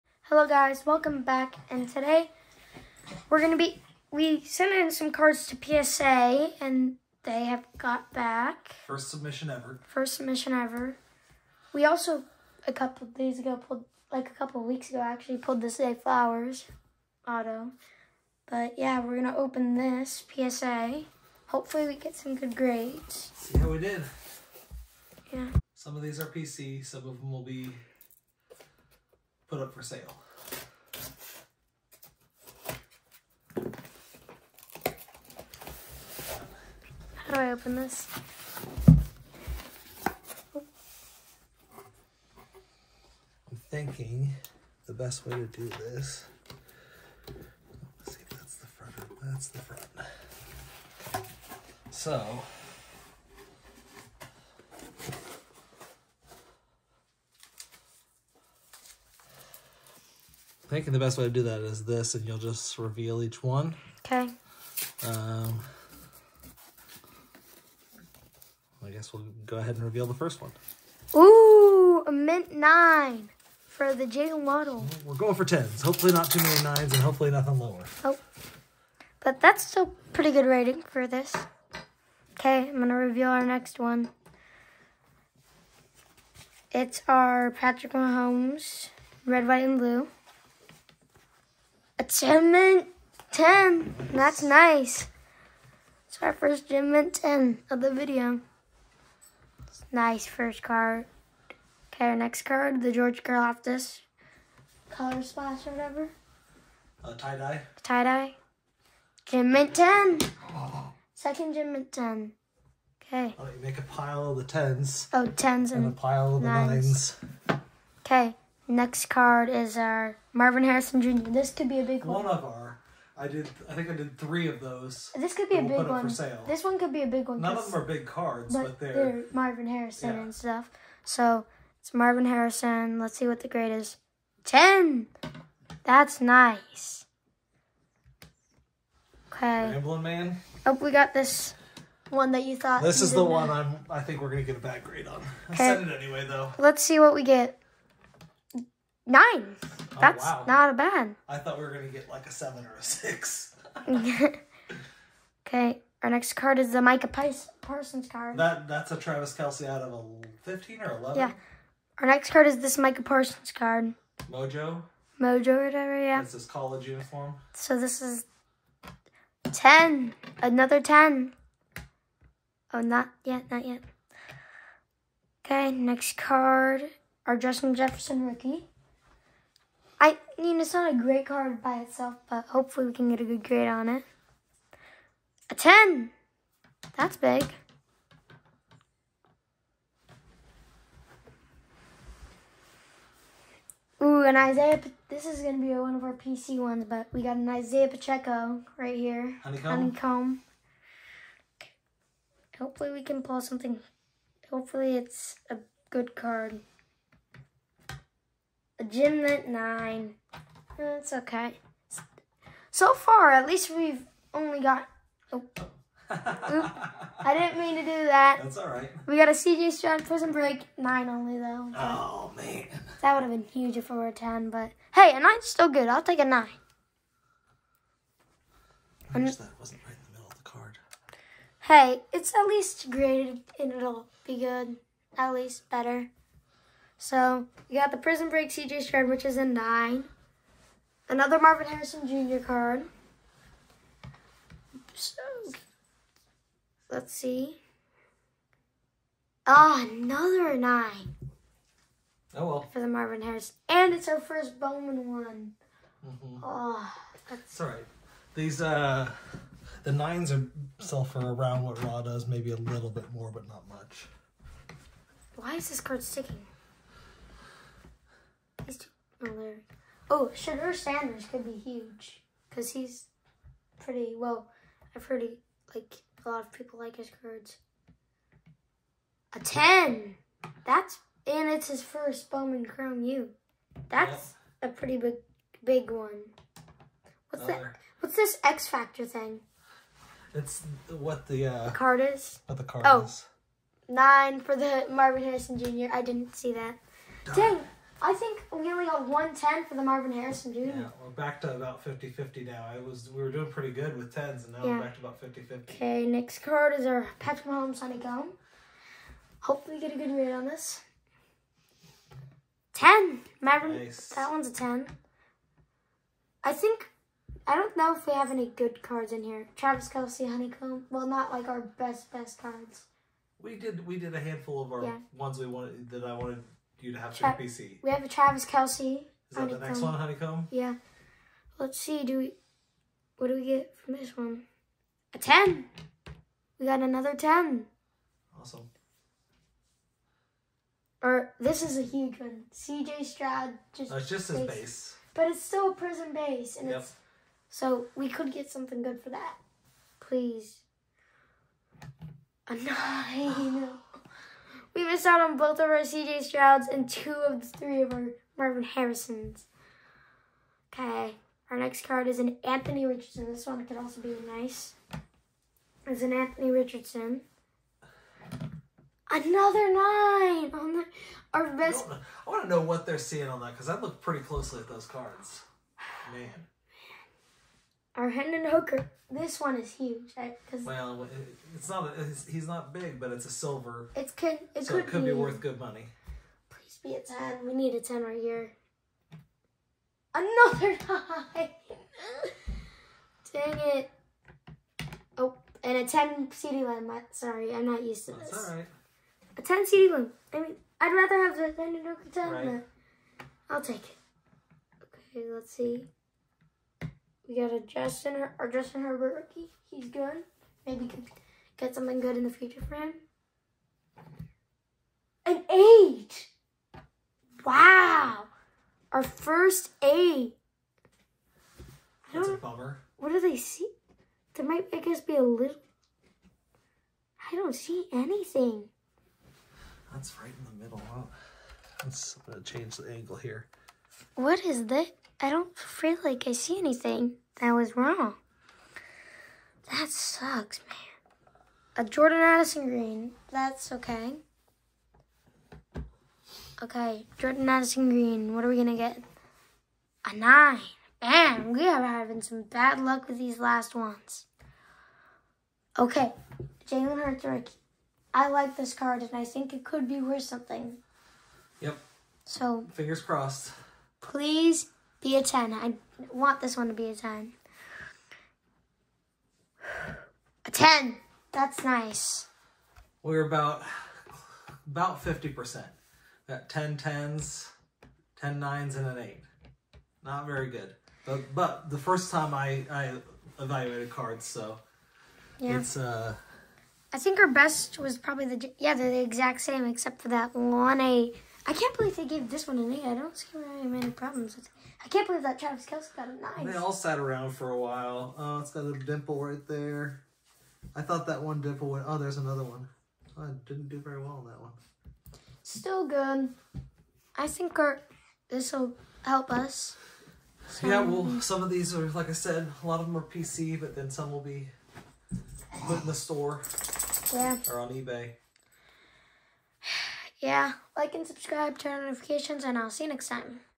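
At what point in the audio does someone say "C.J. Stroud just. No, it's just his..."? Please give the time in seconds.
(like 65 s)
342 s.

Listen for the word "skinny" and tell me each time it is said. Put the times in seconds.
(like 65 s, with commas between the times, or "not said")
not said.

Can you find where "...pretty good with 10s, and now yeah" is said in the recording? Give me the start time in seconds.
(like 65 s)
303 s.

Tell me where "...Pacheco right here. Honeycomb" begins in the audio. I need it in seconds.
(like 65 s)
197 s.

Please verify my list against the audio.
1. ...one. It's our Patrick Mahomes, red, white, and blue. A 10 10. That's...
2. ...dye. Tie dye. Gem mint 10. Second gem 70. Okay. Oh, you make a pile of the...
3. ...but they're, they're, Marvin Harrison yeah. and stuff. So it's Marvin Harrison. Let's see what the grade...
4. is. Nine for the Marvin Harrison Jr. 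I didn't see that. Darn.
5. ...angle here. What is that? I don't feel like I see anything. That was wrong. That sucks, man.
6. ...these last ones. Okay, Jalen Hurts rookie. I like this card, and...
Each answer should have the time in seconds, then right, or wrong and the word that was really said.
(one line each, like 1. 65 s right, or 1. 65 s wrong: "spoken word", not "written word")
1. 83 s right
2. 107 s wrong: "10", not "70"
3. 128 s right
4. 293 s right
5. 432 s right
6. 453 s right.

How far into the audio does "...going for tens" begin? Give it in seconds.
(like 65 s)
75 s.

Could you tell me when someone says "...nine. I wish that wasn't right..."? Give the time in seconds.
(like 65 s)
226 s.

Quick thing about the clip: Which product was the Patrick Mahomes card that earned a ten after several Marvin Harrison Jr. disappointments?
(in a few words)
Sonic Gum.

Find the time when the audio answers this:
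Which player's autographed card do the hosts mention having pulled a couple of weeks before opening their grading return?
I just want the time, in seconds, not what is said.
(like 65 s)
15 s.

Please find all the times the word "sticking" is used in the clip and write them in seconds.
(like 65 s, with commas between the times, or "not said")
266 s.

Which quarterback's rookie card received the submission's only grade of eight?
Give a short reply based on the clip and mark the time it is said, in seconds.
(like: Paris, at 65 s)
Justin Herbert, at 408 s.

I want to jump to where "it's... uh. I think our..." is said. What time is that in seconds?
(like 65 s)
485 s.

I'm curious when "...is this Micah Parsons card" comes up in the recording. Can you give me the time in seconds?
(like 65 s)
162 s.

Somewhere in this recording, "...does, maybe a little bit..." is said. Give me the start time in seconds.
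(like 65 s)
262 s.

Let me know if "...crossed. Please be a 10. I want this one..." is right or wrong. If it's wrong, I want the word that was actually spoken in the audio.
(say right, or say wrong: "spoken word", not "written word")
right.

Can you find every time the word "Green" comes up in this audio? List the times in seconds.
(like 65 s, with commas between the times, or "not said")
442 s, 447 s.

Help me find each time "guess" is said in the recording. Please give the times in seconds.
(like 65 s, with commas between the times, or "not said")
68 s, 424 s.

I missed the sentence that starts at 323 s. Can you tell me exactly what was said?
We did we did a handful of our yeah.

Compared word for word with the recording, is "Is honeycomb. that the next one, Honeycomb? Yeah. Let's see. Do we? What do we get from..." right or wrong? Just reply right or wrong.
right.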